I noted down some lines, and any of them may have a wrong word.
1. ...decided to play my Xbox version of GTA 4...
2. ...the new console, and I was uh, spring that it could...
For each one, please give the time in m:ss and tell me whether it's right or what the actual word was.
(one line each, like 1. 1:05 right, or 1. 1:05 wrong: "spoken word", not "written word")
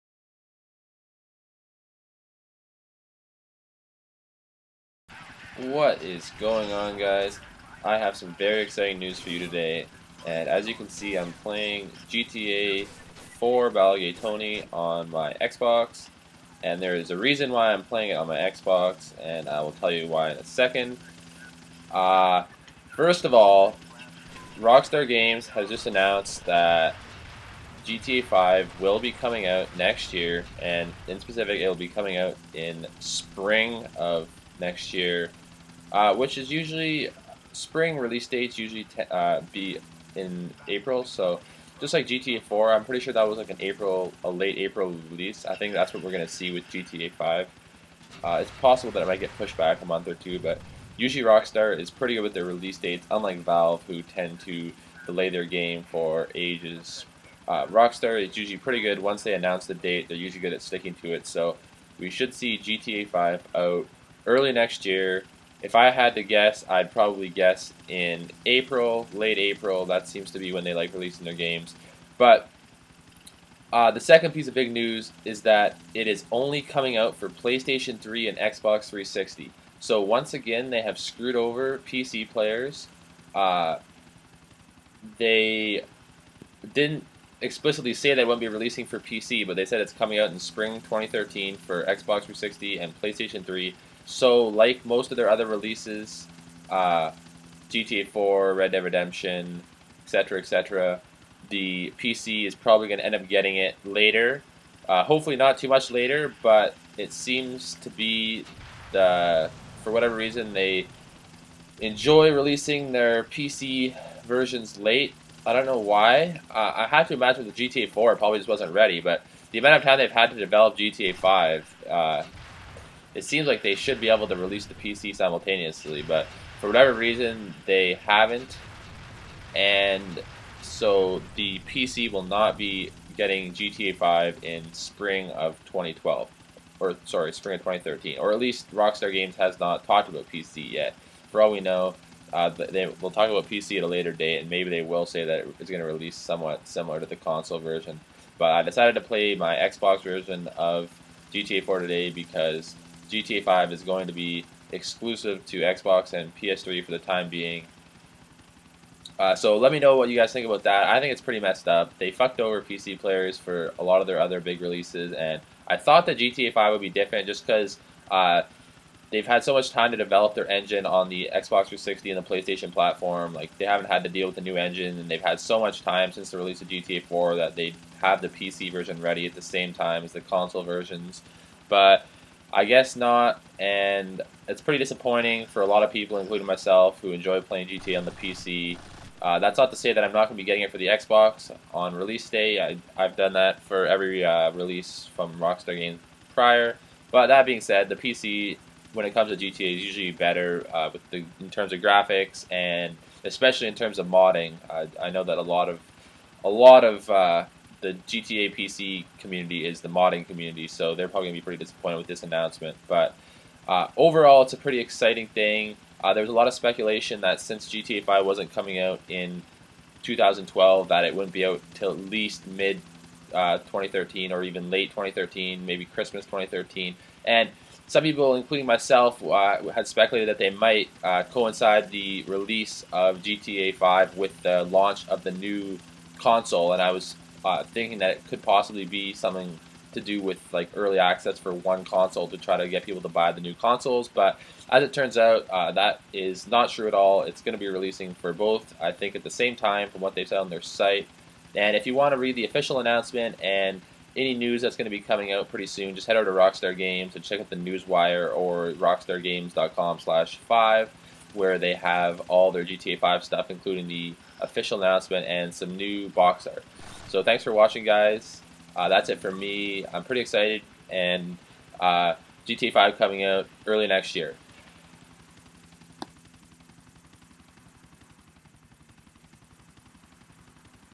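1. 2:28 right
2. 3:55 wrong: "thinking", not "spring".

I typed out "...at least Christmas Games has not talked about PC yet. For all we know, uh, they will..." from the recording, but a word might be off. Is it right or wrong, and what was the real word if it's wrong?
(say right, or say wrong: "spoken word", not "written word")
wrong: "Rockstar", not "Christmas".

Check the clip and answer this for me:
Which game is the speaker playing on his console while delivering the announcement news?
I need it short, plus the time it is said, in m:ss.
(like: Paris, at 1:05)
GTA 4 Ballad of Gay Tony, at 0:12.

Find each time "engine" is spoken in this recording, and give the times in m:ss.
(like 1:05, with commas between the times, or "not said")
2:50, 2:54.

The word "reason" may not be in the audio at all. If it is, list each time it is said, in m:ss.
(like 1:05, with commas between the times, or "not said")
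0:17, 1:50, 2:06.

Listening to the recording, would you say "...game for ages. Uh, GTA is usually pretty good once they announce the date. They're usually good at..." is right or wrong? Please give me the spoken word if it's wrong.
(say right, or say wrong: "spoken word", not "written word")
wrong: "Rockstar", not "GTA".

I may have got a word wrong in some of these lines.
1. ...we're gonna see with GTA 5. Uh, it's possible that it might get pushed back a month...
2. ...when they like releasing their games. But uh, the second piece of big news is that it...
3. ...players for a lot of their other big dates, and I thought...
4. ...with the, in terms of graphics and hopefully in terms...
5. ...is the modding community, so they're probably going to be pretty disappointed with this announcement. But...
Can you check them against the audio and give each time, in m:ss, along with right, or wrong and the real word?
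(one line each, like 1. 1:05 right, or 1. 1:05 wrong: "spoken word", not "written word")
1. 0:46 right
2. 1:10 right
3. 2:42 wrong: "releases", not "dates"
4. 3:20 wrong: "especially", not "hopefully"
5. 3:29 right.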